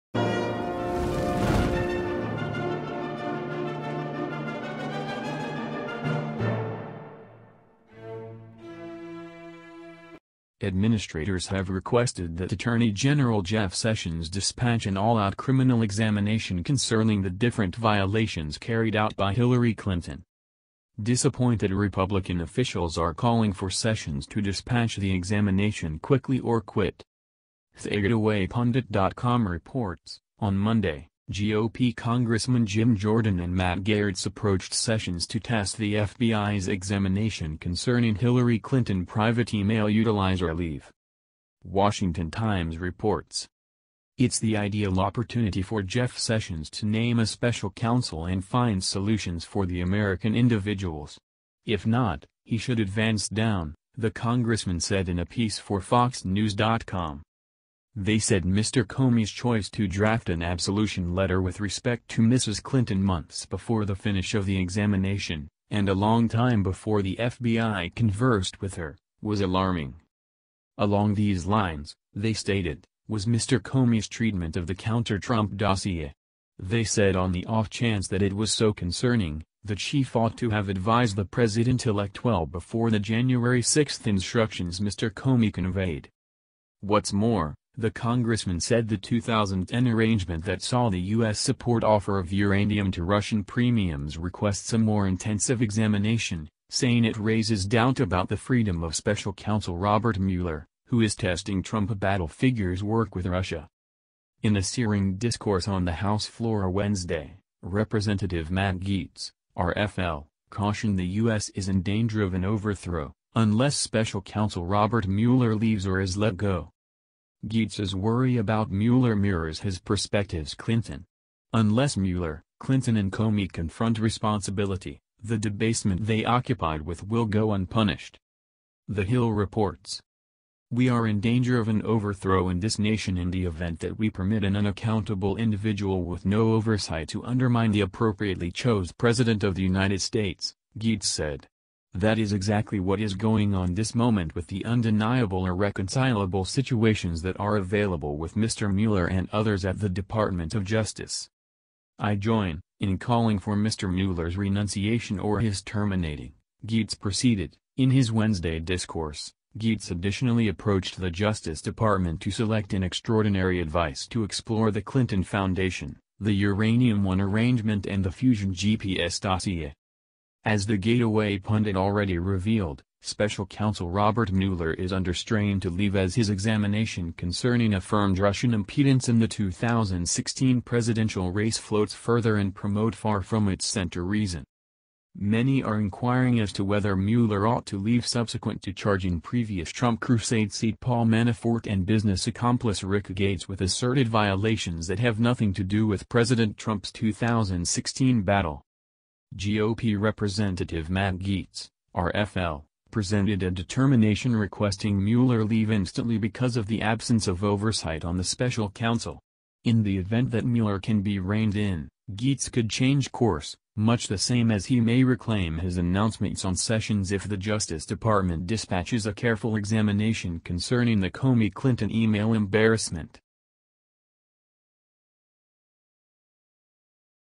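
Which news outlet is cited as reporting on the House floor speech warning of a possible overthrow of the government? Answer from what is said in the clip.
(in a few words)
The Hill.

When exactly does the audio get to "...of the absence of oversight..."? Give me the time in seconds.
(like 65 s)
206 s.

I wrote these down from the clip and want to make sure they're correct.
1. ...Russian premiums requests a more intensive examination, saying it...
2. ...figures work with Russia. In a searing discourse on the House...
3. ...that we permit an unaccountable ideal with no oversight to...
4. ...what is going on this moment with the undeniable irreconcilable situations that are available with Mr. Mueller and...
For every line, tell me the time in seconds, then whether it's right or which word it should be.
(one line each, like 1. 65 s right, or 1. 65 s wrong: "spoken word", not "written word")
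1. 93 s right
2. 102 s right
3. 133 s wrong: "individual", not "ideal"
4. 142 s right.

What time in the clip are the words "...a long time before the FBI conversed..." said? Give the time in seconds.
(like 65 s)
65 s.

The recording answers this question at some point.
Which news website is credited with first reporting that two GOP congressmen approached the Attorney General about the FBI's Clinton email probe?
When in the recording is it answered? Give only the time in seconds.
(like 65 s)
27 s.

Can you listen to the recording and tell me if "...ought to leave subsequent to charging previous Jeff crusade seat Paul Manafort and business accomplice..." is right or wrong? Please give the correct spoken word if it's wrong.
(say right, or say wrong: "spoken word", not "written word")
wrong: "Trump", not "Jeff".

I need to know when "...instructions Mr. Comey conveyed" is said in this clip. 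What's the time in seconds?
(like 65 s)
84 s.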